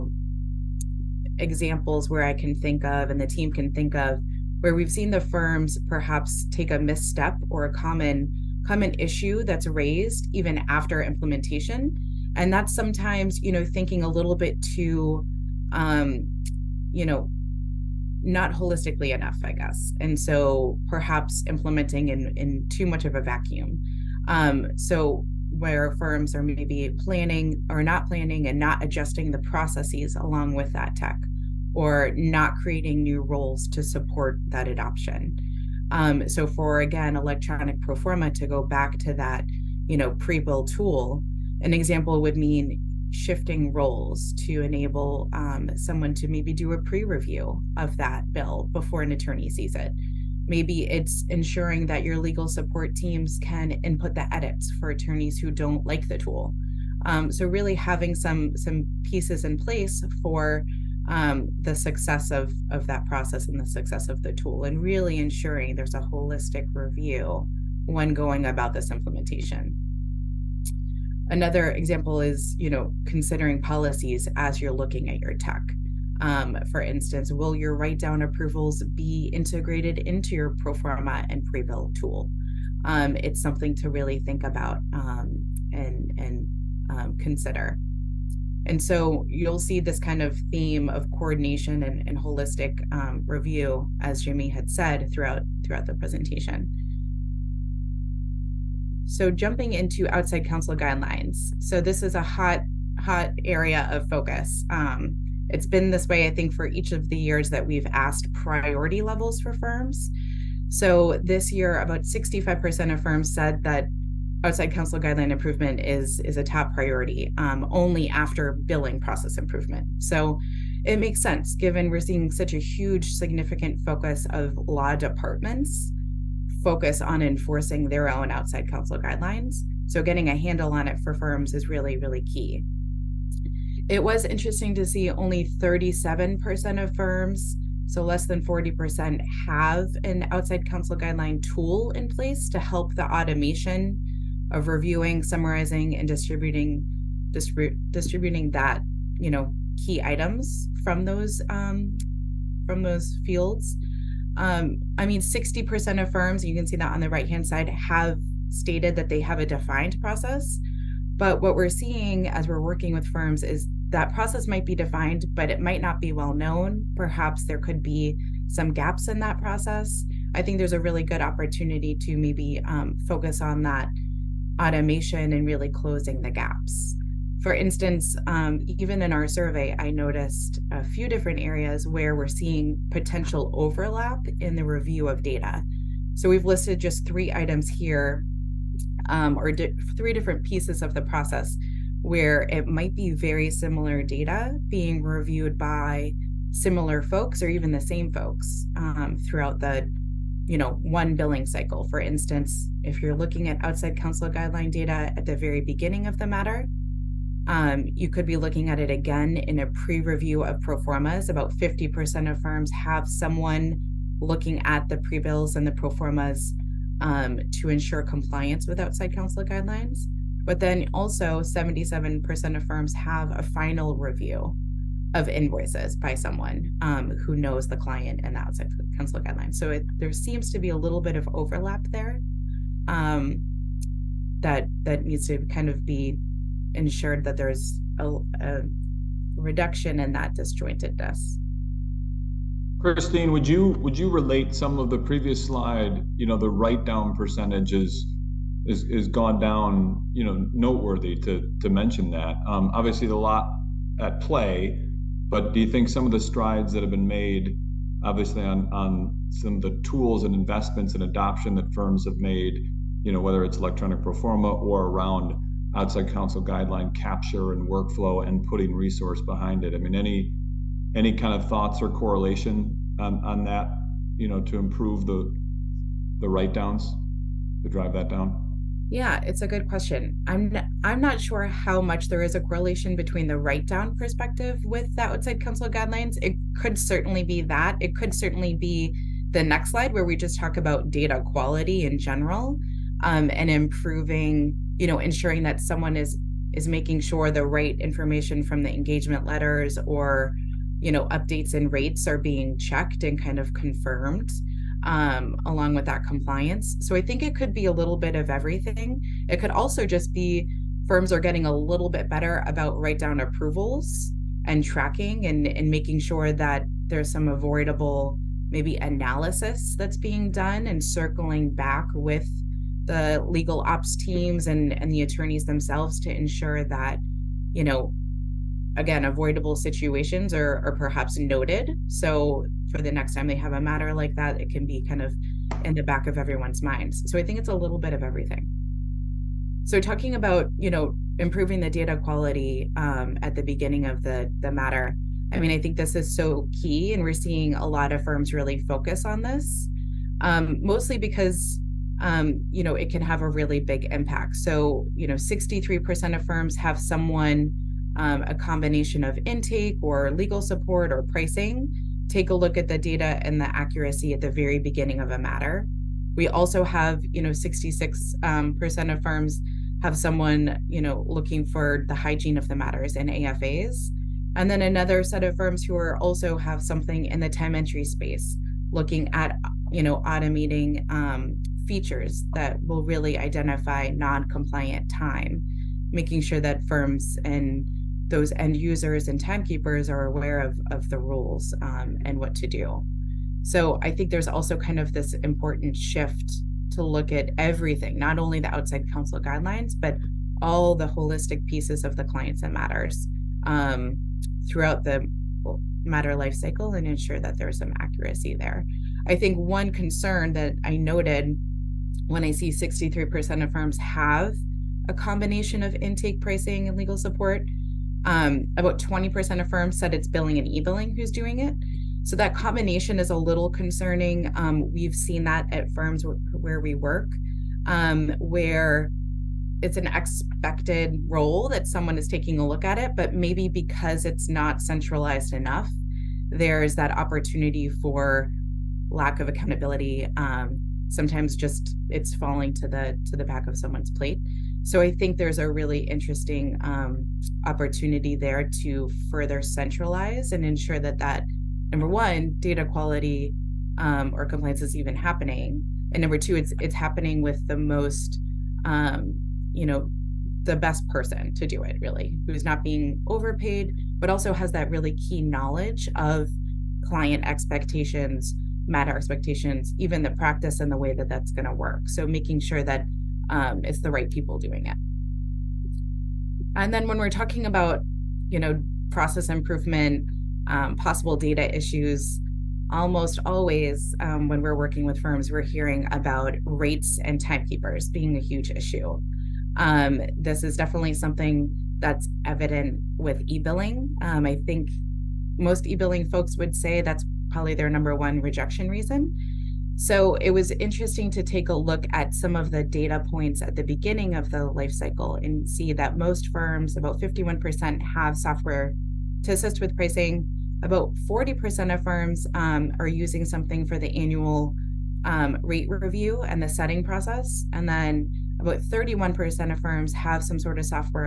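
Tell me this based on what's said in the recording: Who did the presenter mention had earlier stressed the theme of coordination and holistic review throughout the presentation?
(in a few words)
Jimmy.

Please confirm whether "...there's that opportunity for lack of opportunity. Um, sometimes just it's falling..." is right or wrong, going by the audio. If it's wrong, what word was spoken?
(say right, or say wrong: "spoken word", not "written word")
wrong: "accountability", not "opportunity".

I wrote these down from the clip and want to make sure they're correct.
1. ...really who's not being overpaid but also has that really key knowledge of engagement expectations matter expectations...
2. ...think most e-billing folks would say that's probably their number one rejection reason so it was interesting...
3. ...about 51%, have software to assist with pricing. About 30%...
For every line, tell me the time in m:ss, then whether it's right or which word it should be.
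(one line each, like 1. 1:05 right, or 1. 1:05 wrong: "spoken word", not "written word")
1. 7:41 wrong: "client", not "engagement"
2. 8:14 right
3. 8:26 wrong: "40", not "30".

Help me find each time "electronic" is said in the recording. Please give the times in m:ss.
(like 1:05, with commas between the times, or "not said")
0:37, 4:23.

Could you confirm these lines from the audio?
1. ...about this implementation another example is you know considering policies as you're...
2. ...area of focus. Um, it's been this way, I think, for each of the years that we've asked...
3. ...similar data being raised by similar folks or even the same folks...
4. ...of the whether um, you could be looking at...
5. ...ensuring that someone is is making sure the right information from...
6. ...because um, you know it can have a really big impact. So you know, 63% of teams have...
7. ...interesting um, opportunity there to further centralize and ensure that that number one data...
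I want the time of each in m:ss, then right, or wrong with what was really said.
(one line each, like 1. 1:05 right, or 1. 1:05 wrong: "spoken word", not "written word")
1. 1:08 right
2. 1:43 right
3. 3:13 wrong: "reviewed", not "raised"
4. 3:26 wrong: "matter", not "whether"
5. 4:54 right
6. 5:50 wrong: "firms", not "teams"
7. 7:25 right.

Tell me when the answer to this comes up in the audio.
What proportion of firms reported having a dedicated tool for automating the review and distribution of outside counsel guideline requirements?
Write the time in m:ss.
2:15.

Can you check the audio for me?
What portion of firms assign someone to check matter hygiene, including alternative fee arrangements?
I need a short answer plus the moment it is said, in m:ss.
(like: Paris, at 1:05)
66%, at 6:07.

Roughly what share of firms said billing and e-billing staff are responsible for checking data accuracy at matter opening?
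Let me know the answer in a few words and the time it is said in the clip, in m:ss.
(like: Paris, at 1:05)
20%, at 6:58.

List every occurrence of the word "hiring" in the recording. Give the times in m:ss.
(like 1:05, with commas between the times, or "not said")
not said.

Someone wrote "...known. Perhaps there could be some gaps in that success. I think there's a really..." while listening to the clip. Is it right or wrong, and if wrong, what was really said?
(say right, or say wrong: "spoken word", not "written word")
wrong: "process", not "success".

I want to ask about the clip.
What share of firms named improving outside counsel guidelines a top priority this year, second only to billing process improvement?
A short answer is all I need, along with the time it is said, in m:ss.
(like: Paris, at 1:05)
65%, at 1:52.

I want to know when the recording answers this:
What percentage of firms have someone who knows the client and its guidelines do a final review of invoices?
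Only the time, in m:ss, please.
3:41.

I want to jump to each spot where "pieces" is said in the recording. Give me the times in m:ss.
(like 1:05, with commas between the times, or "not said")
0:59, 3:10, 6:41.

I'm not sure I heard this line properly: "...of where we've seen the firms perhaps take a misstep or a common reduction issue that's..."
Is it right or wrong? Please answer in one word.
wrong.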